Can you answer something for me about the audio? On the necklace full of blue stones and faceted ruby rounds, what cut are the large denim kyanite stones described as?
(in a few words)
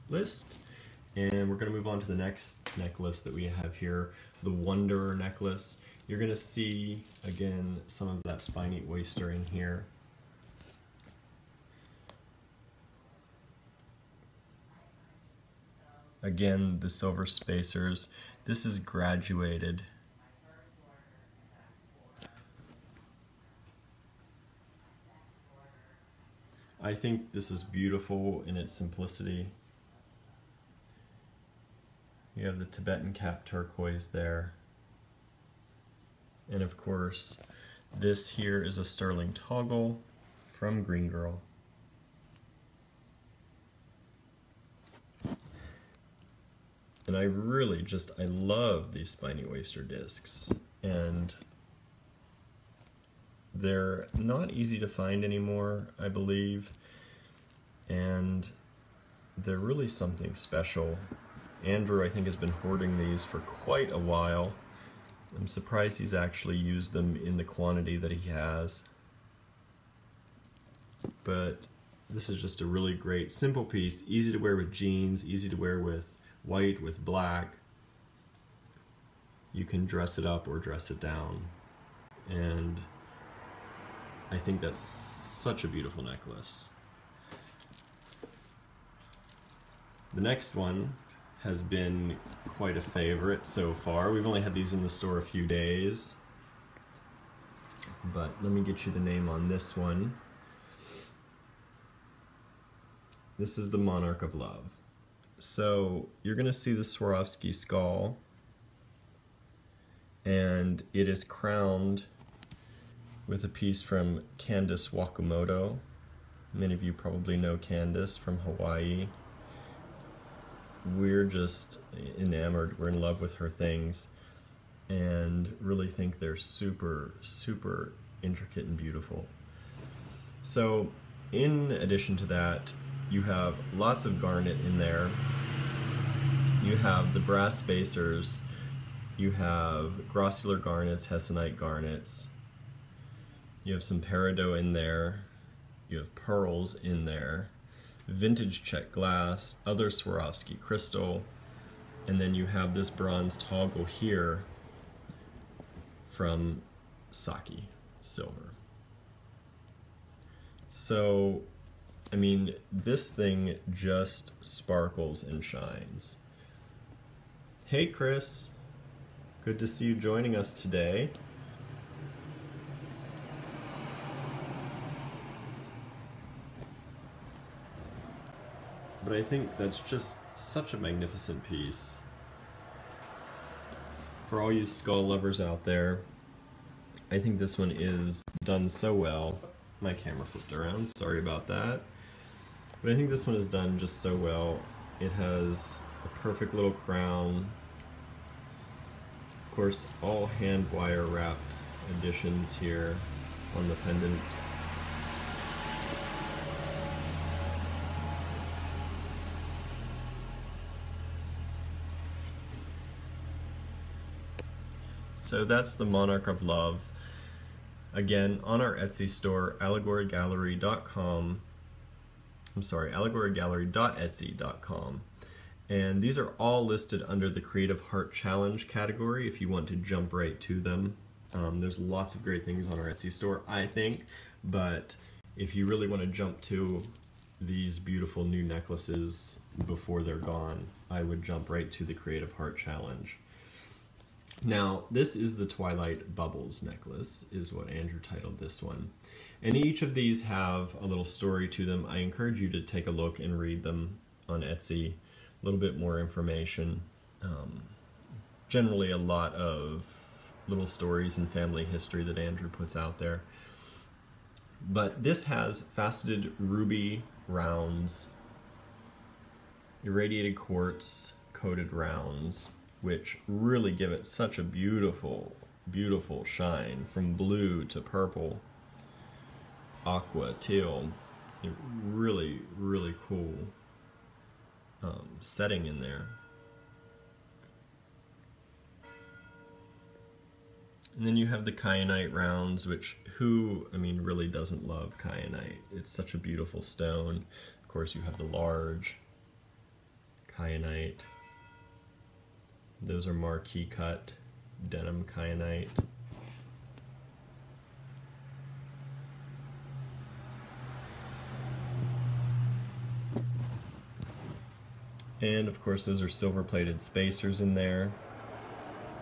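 marquee cut.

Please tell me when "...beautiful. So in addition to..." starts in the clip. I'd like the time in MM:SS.
02:08.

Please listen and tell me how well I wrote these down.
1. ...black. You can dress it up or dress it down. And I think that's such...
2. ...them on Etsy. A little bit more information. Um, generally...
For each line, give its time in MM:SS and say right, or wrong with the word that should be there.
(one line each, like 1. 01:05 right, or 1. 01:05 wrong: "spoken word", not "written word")
1. 01:17 right
2. 04:13 right.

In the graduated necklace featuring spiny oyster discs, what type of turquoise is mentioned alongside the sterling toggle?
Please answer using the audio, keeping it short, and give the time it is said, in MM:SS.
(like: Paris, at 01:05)
Tibetan cap turquoise, at 00:32.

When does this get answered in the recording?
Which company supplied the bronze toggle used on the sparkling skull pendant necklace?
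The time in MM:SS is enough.
02:37.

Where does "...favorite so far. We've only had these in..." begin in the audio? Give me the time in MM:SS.
01:32.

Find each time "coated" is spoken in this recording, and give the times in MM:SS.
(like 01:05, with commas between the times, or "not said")
04:31.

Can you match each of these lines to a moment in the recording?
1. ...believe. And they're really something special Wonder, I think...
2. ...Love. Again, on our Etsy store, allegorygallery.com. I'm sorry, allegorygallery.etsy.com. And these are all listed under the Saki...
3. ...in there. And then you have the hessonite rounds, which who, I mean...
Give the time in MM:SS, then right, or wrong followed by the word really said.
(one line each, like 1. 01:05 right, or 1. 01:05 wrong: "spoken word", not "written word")
1. 00:56 wrong: "Andrew", not "Wonder"
2. 03:36 wrong: "Creative", not "Saki"
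3. 04:45 wrong: "kyanite", not "hessonite".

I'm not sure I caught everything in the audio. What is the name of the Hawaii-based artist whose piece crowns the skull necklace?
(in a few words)
Candace Wakamoto.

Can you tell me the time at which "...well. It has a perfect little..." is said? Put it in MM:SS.
03:14.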